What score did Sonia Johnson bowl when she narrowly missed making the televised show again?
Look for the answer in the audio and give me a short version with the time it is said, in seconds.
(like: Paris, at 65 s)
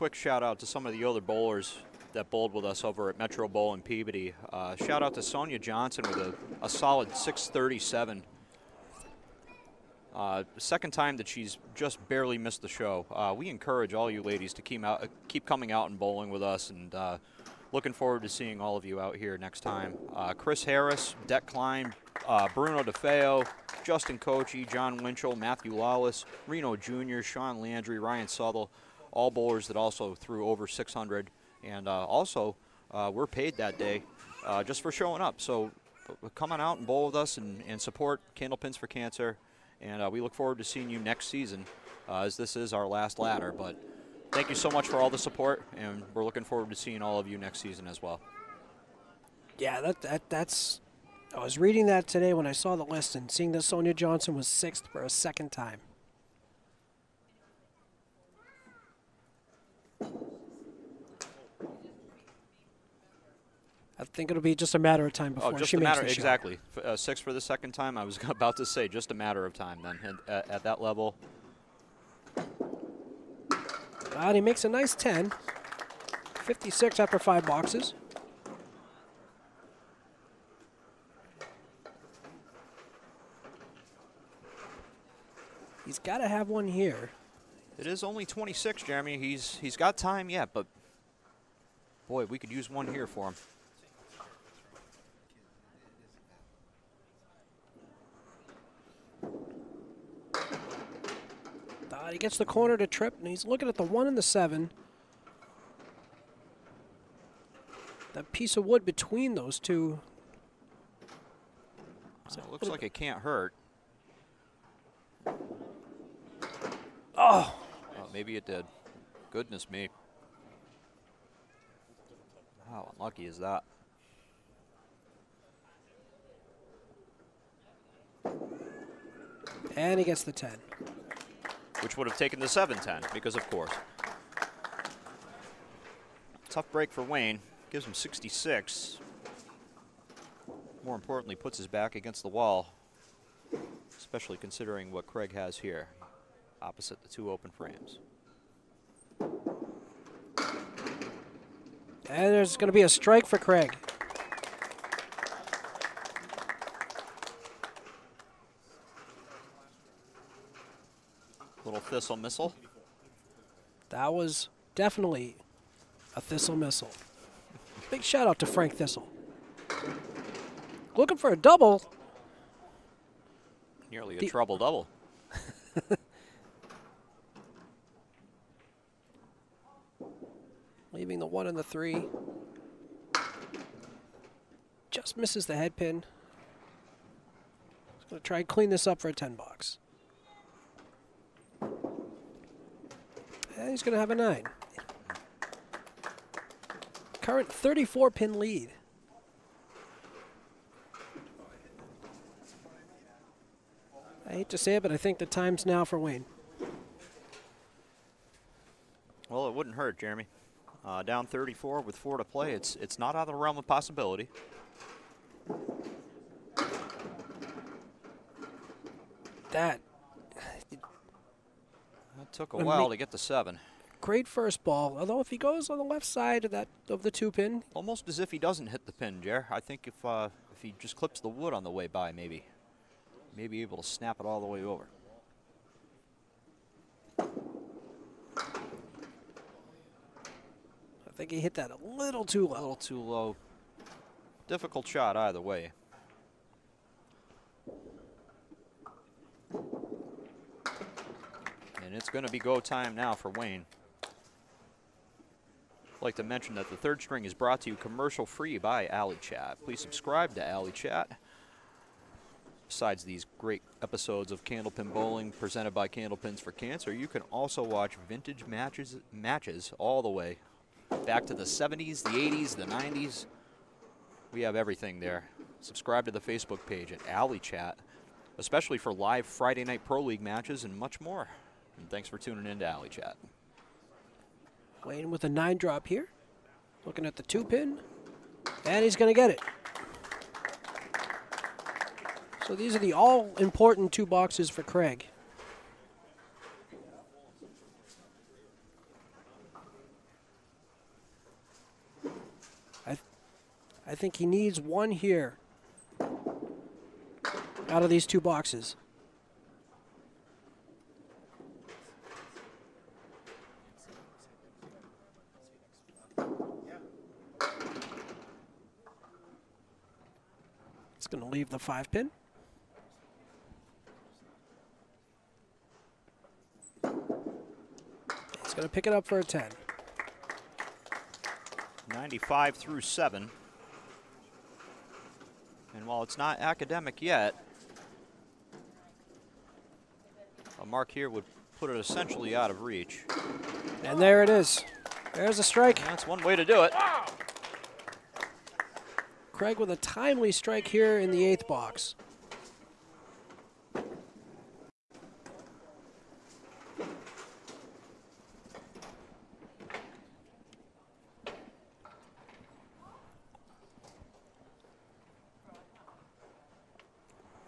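637, at 7 s.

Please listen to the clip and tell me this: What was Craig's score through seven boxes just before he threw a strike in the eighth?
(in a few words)
95.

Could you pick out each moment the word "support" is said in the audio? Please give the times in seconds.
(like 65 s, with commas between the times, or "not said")
37 s, 45 s.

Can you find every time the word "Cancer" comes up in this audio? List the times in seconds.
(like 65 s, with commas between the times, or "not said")
38 s, 266 s.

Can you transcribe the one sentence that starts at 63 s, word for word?
I think it'll be just a matter of time oh, before oh, just she a matter, exactly.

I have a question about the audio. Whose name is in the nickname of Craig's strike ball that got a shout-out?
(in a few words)
Frank Thistle.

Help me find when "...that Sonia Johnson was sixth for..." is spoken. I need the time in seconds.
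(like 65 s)
53 s.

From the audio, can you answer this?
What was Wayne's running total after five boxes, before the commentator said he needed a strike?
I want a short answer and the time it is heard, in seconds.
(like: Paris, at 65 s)
56, at 76 s.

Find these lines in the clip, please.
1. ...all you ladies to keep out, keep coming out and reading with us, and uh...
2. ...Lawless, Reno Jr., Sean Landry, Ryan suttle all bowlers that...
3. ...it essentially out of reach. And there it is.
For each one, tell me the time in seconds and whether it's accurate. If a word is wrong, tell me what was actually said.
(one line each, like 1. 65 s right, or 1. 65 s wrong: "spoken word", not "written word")
1. 13 s wrong: "bowling", not "reading"
2. 25 s right
3. 341 s right.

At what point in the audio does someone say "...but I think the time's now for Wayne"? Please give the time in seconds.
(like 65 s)
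204 s.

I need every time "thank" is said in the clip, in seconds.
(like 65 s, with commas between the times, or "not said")
44 s, 281 s.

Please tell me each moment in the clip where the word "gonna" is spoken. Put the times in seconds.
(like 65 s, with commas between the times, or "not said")
188 s, 193 s.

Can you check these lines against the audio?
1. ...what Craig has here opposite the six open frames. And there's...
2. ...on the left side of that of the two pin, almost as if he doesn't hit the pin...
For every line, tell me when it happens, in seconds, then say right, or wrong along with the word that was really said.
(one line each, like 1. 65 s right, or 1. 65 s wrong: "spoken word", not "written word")
1. 144 s wrong: "two", not "six"
2. 225 s right.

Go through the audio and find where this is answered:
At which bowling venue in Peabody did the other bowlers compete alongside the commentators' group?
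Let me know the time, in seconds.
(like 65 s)
3 s.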